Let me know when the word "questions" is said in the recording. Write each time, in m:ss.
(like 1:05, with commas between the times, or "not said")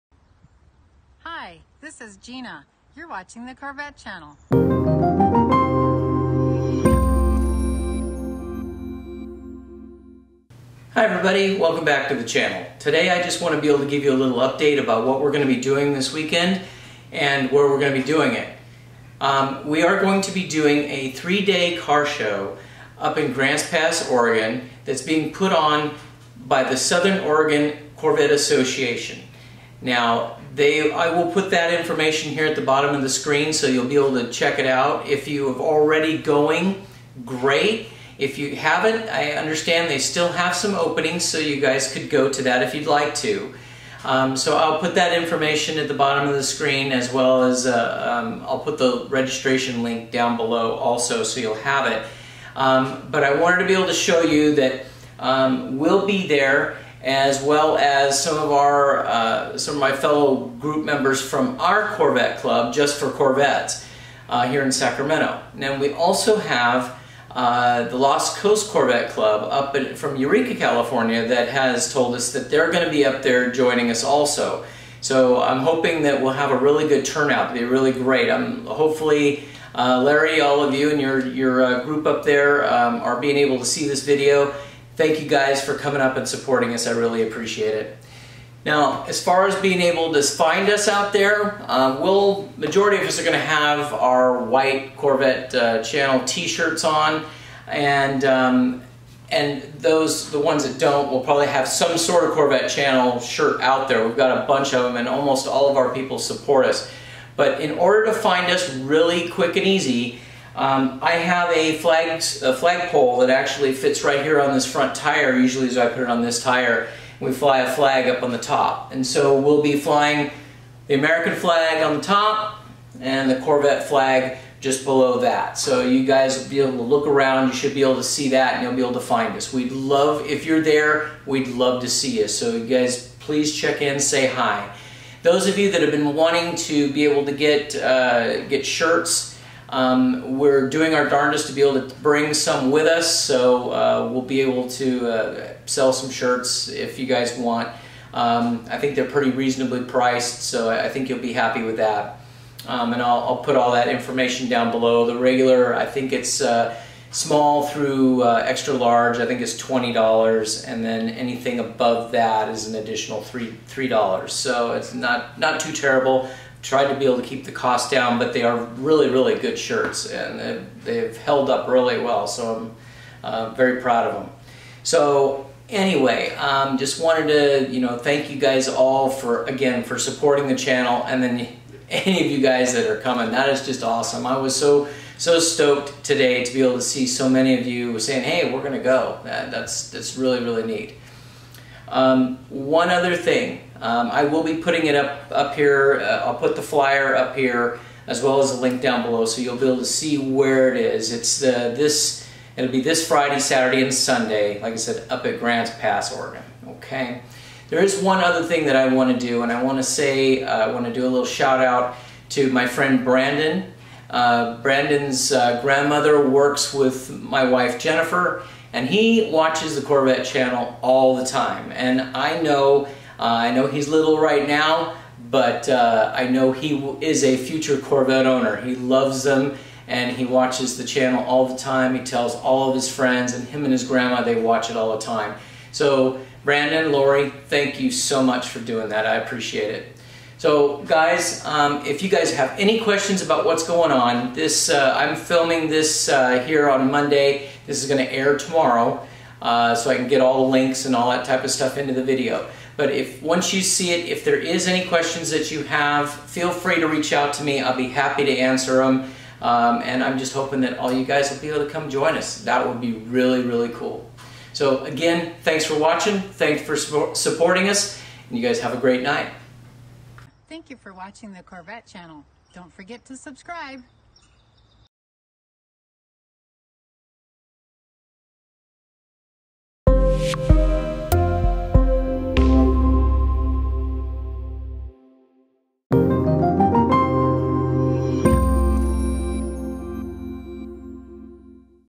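4:02, 4:14.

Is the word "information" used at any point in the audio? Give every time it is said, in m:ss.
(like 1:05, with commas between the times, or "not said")
0:31, 0:45, 2:33.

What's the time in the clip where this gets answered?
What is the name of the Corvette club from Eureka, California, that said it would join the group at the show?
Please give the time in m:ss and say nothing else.
1:07.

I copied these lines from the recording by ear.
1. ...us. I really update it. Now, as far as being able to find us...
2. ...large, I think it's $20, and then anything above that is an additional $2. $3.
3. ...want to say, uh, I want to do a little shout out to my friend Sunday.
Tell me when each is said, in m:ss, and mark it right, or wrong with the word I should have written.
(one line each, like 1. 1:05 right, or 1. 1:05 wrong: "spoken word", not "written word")
1. 1:26 wrong: "appreciate", not "update"
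2. 2:38 wrong: "3", not "2"
3. 3:29 wrong: "Brandon", not "Sunday".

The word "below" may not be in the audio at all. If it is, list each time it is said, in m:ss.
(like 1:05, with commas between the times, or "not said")
0:50, 2:04, 2:34, 3:19.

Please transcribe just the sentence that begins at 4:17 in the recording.
I'll be happy to answer them.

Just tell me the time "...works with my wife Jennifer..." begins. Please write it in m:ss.
3:36.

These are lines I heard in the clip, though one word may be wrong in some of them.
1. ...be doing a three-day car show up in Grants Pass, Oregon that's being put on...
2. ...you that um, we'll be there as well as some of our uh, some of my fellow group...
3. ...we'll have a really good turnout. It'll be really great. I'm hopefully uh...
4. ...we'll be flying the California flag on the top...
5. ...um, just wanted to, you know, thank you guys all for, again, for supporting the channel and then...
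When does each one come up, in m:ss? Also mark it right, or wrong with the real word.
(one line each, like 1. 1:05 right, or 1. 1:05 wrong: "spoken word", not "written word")
1. 0:20 right
2. 0:54 right
3. 1:16 right
4. 1:59 wrong: "American", not "California"
5. 2:56 right.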